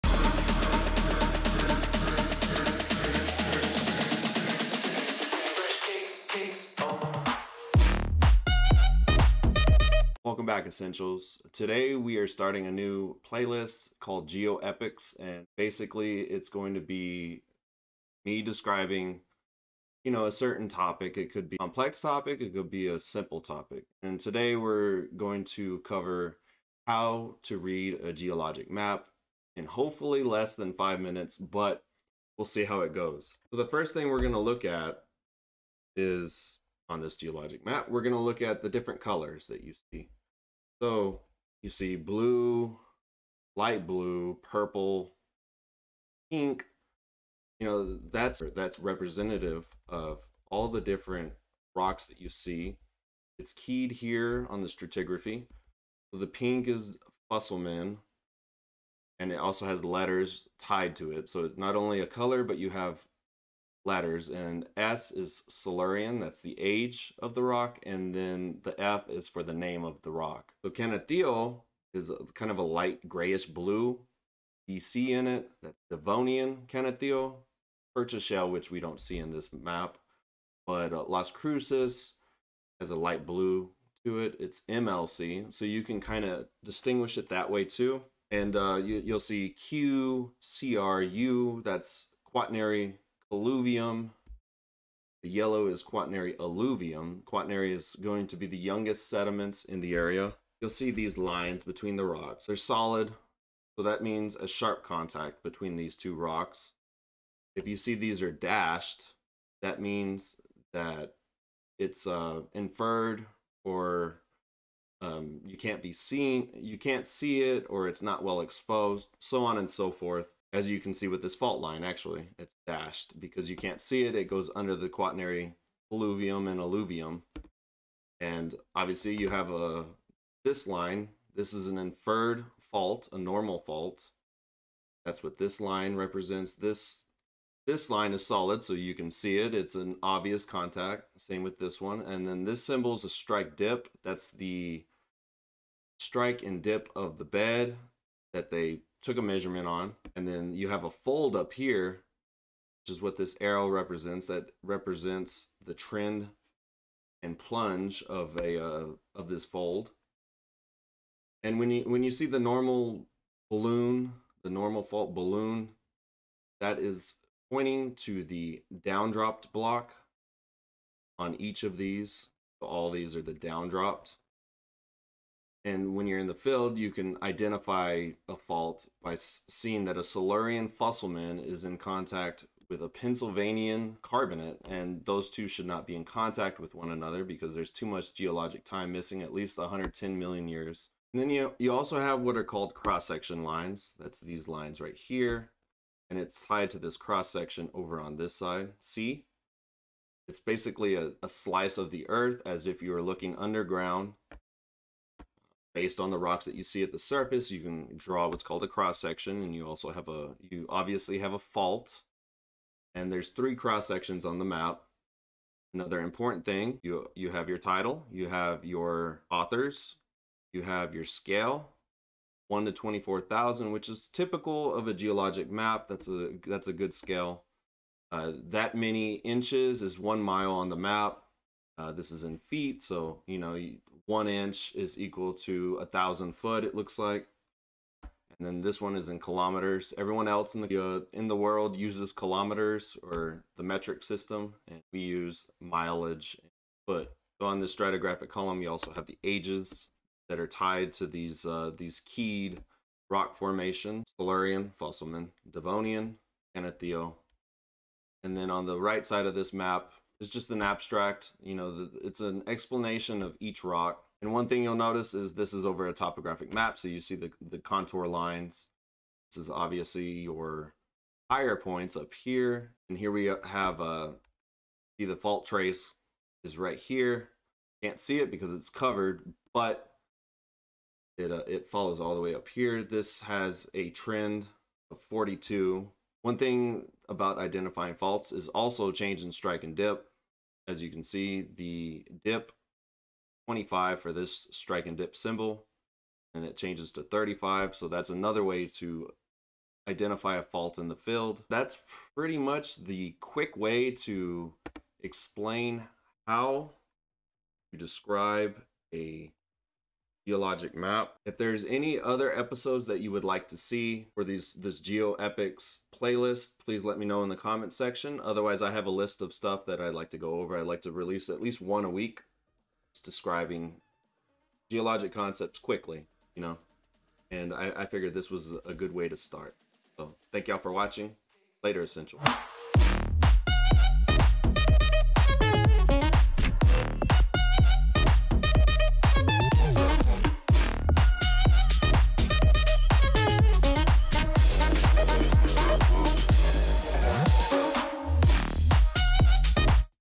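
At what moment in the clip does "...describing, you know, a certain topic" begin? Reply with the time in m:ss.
0:18.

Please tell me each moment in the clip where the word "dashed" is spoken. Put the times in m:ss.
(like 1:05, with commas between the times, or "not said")
1:48, 2:02.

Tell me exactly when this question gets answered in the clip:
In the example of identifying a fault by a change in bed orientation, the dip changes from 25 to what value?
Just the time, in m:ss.
4:56.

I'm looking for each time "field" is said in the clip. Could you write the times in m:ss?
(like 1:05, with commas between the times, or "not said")
2:56, 5:00.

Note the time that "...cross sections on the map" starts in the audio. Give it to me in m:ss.
3:33.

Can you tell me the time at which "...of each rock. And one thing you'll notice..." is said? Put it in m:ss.
4:23.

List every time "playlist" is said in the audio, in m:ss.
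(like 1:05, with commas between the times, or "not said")
0:13, 5:15.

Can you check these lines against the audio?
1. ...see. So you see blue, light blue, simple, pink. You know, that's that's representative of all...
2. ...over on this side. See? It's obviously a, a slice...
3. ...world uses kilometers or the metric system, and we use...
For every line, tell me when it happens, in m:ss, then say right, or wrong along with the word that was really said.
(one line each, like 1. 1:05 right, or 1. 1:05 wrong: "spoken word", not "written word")
1. 0:39 wrong: "purple", not "simple"
2. 3:17 wrong: "basically", not "obviously"
3. 4:01 right.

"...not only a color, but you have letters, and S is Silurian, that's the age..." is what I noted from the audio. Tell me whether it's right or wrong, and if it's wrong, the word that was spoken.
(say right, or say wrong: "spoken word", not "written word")
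right.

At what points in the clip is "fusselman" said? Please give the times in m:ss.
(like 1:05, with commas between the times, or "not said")
0:57, 3:00, 4:14.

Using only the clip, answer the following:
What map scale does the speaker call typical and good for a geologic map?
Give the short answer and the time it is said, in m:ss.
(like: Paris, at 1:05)
1 to 24,000, at 3:42.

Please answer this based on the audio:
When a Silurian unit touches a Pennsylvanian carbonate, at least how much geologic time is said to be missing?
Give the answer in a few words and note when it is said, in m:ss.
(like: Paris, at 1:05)
110 million years, at 3:09.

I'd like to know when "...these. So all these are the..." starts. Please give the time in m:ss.
2:51.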